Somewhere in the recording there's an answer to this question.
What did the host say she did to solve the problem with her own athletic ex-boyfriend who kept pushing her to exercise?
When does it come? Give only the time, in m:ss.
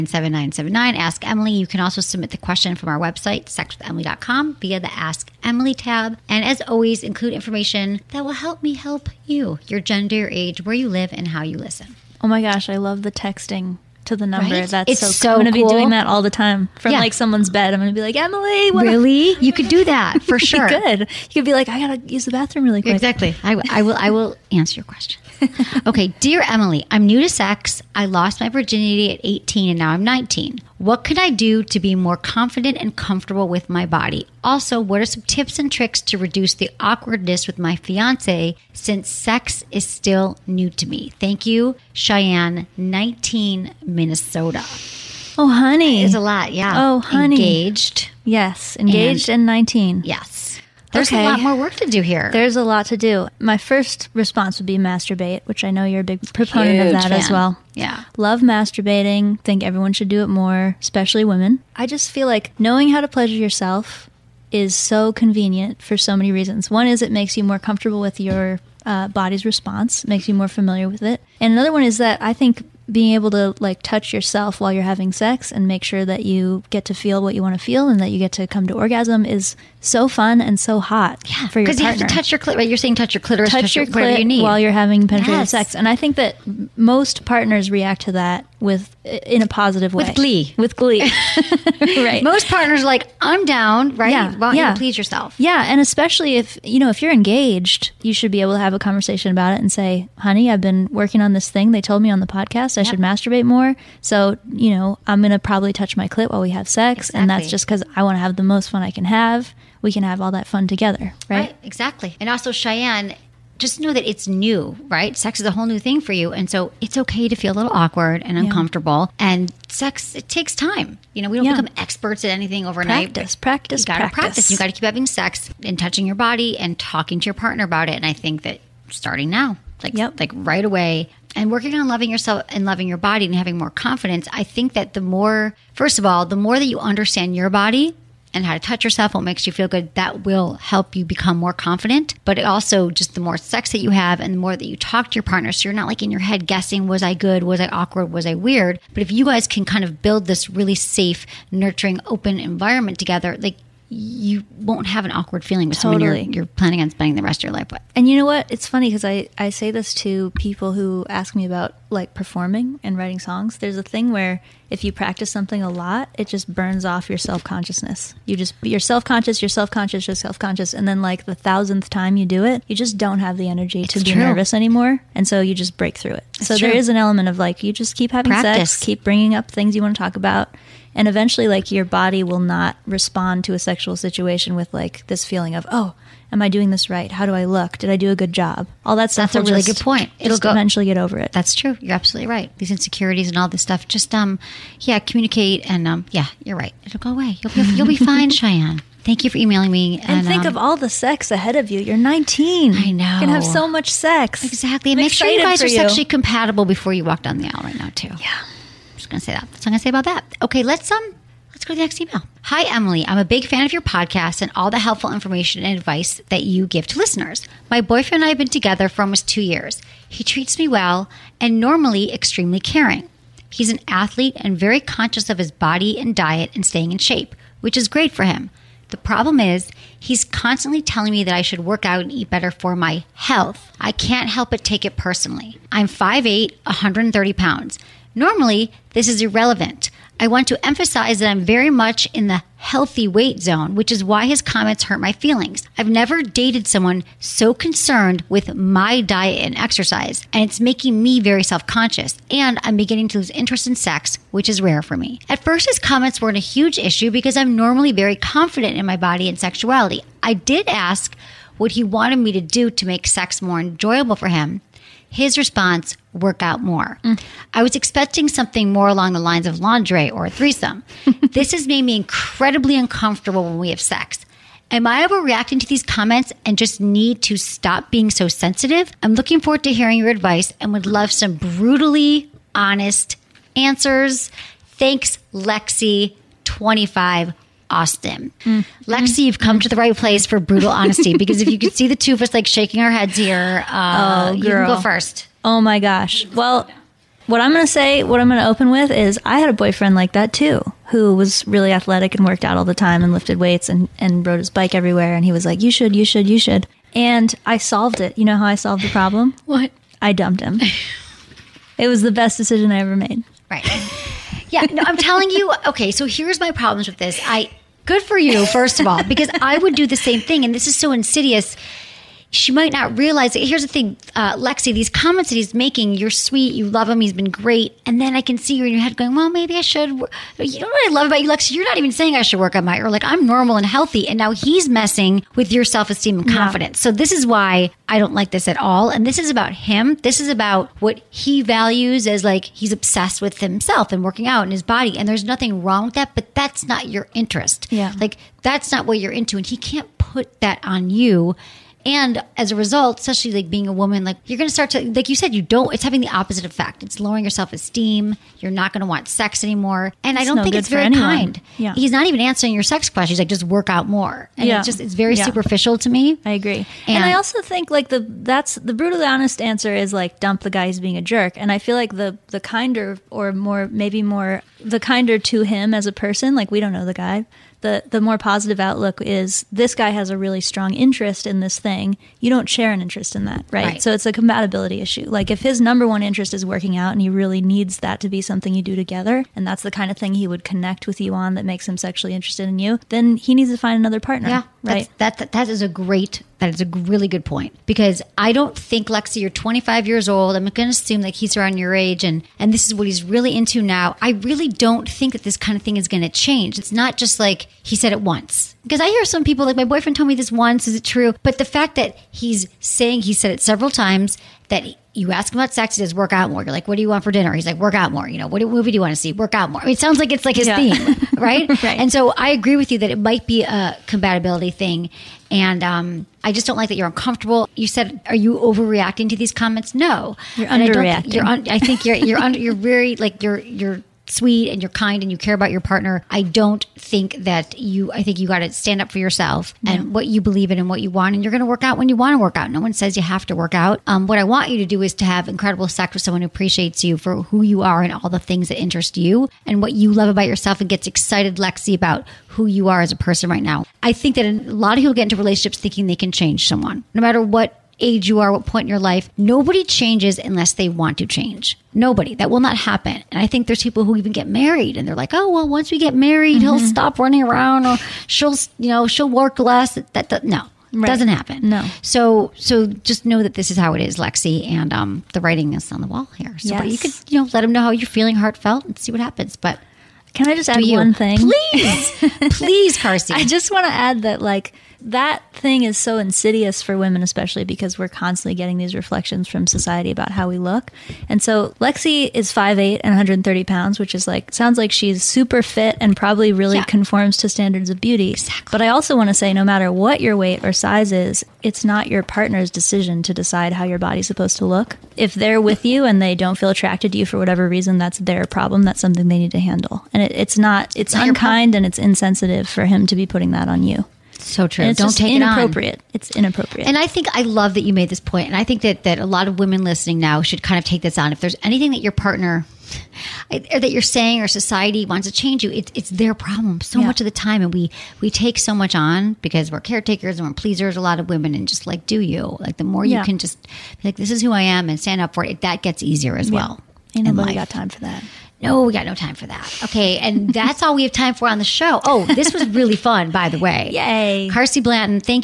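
5:10.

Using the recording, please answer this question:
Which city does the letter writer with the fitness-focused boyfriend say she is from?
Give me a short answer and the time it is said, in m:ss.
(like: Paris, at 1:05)
Austin, at 4:47.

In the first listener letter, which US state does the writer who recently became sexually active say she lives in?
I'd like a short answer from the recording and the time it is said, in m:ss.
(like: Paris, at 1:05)
Minnesota, at 0:43.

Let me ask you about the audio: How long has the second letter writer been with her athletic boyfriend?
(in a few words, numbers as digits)
almost 2 years.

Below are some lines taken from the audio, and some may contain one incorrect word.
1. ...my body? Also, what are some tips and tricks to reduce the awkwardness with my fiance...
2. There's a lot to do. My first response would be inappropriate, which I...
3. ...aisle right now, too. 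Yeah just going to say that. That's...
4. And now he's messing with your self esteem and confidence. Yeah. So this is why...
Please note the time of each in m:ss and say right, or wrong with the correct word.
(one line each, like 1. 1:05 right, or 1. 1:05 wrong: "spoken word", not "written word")
1. 0:33 right
2. 0:52 wrong: "masturbate", not "inappropriate"
3. 3:27 right
4. 5:34 right.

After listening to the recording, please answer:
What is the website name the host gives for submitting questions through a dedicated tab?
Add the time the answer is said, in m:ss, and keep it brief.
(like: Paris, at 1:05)
sexwithemily.com, at 0:03.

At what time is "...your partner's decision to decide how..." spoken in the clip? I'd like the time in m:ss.
8:21.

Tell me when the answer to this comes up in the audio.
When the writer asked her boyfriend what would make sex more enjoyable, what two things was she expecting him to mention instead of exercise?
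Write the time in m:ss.
4:29.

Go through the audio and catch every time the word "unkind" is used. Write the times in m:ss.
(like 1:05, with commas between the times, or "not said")
8:31.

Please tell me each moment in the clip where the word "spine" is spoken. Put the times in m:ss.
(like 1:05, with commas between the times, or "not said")
not said.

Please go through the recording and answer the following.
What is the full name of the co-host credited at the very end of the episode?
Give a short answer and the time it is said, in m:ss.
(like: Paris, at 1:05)
Carsie Blanton, at 9:04.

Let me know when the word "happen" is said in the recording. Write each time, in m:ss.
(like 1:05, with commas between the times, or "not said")
7:42, 7:51, 7:59.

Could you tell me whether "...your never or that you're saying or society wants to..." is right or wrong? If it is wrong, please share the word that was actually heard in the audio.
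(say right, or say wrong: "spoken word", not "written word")
wrong: "partner", not "never".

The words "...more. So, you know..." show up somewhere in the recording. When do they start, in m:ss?
1:43.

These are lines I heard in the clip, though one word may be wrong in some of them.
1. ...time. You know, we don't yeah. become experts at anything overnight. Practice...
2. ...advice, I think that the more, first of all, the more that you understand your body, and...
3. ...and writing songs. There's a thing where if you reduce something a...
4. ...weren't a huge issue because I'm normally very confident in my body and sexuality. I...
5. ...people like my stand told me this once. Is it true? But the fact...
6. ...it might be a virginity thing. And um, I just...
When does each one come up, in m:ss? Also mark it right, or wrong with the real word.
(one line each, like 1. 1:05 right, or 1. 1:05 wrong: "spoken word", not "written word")
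1. 2:00 right
2. 2:13 wrong: "confidence", not "advice"
3. 2:42 wrong: "practice", not "reduce"
4. 4:16 right
5. 6:49 wrong: "boyfriend", not "stand"
6. 7:02 wrong: "compatibility", not "virginity".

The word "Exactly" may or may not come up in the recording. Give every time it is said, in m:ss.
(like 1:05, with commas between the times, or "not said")
0:22, 1:47, 1:51, 3:24, 8:18.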